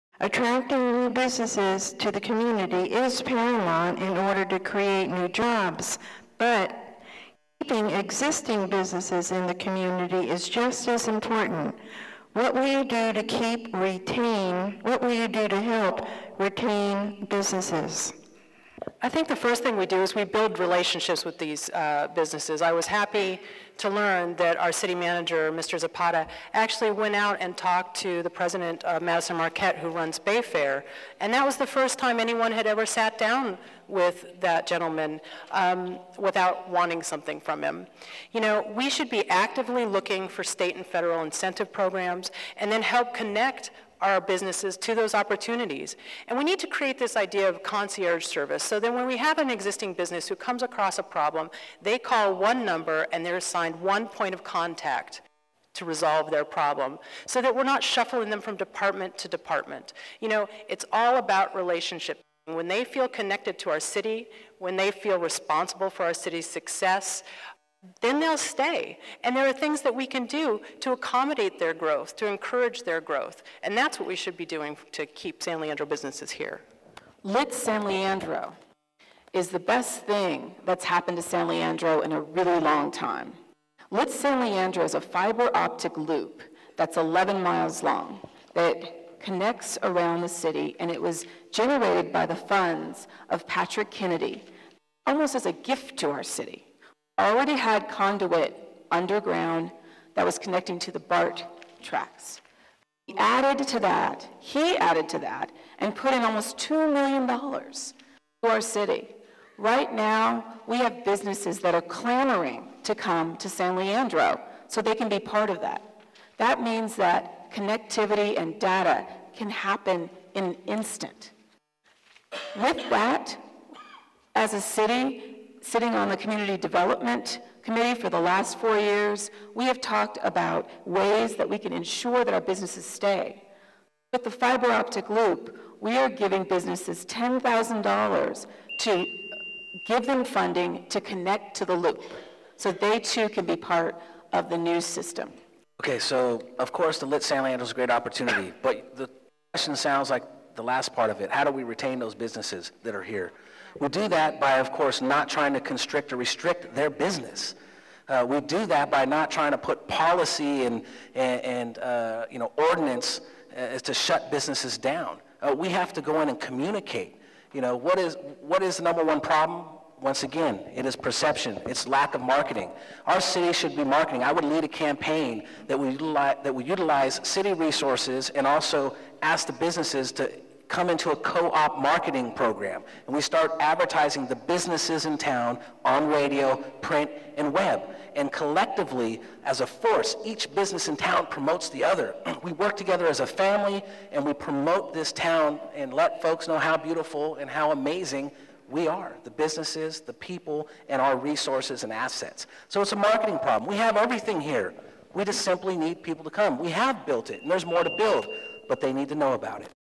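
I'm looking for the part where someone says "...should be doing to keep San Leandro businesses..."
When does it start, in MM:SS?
01:14.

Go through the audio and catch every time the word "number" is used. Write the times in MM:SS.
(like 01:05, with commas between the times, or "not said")
00:52, 02:48.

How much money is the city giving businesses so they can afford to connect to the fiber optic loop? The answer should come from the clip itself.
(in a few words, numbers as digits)
$10,000.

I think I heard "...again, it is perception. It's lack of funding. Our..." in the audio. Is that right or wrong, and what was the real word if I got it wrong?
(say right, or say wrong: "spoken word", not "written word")
wrong: "marketing", not "funding".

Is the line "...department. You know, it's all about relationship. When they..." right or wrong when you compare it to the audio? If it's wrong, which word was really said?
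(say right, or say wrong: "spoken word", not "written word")
right.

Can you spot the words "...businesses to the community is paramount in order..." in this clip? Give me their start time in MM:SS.
00:01.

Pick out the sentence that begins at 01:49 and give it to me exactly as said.
Right now, we have businesses that are clamoring to come to San Leandro so they can be part of that.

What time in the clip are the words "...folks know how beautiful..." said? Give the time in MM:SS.
03:16.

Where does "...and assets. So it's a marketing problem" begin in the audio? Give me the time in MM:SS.
03:21.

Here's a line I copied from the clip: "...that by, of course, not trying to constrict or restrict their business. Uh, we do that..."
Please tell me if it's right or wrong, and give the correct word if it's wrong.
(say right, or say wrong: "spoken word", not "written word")
right.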